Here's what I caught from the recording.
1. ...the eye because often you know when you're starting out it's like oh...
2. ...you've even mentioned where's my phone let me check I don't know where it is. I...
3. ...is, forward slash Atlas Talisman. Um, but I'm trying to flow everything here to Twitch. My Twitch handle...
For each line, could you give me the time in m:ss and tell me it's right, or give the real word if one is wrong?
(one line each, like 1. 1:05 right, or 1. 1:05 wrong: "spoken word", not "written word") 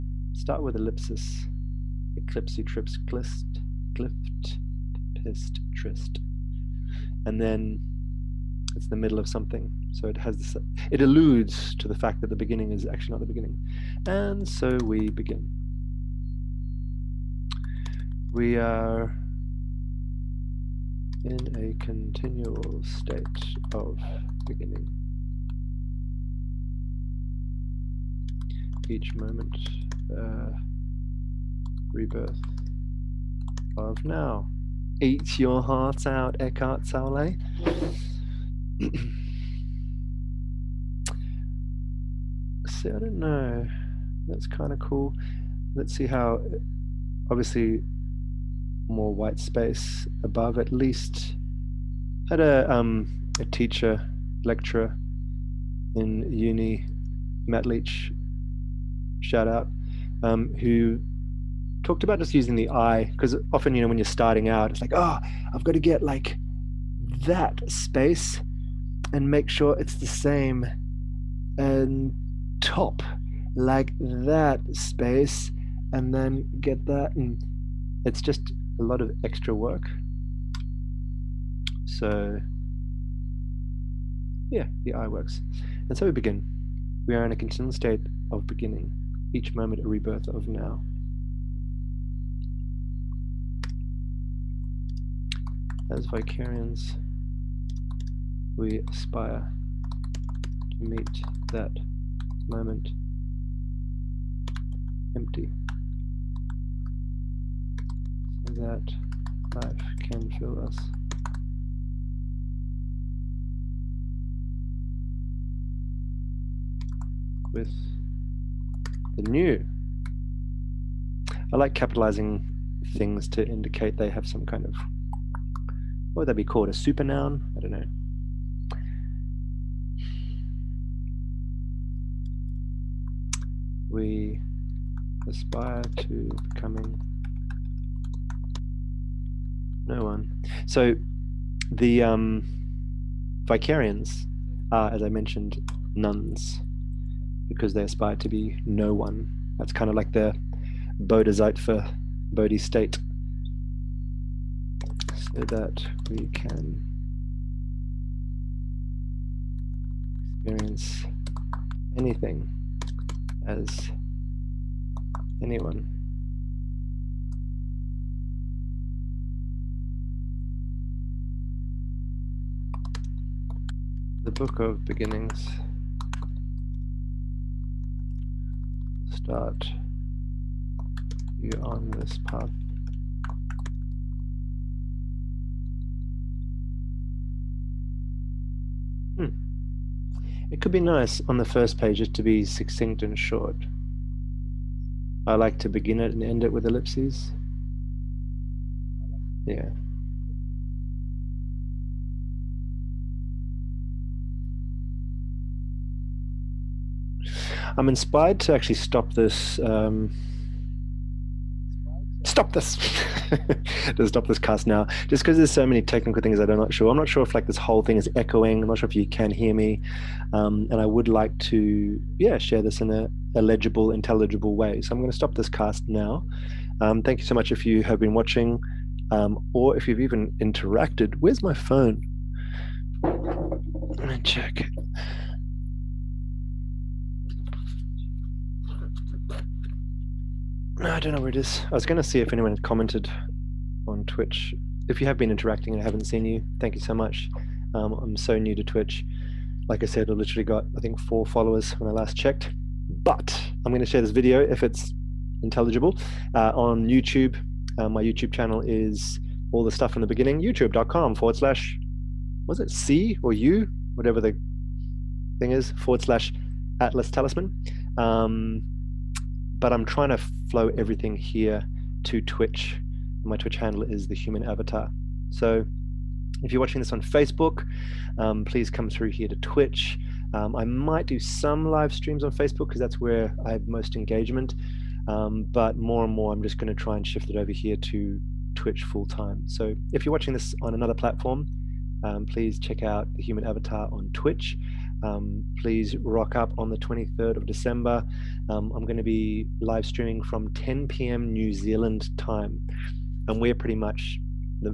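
1. 1:02 right
2. 3:49 wrong: "interacted", not "mentioned"
3. 4:25 right.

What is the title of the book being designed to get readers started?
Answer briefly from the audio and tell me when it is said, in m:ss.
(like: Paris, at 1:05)
The Book of Beginnings, at 2:54.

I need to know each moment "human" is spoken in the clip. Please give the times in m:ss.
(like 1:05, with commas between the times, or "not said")
4:34, 4:53.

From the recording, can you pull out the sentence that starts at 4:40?
Um, I might do some live streams on Facebook because that's where I have most engagement.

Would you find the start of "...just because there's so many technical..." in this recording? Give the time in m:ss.
3:35.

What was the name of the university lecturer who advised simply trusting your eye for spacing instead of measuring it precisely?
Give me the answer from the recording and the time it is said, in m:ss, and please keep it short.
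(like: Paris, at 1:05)
Matt Leach, at 0:57.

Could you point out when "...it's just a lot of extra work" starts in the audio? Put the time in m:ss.
1:18.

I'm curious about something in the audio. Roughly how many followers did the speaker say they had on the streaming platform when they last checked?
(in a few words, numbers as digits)
4.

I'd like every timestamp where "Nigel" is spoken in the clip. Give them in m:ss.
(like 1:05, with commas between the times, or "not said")
not said.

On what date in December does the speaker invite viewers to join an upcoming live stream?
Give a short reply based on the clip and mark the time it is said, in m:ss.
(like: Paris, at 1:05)
23rd of December, at 4:56.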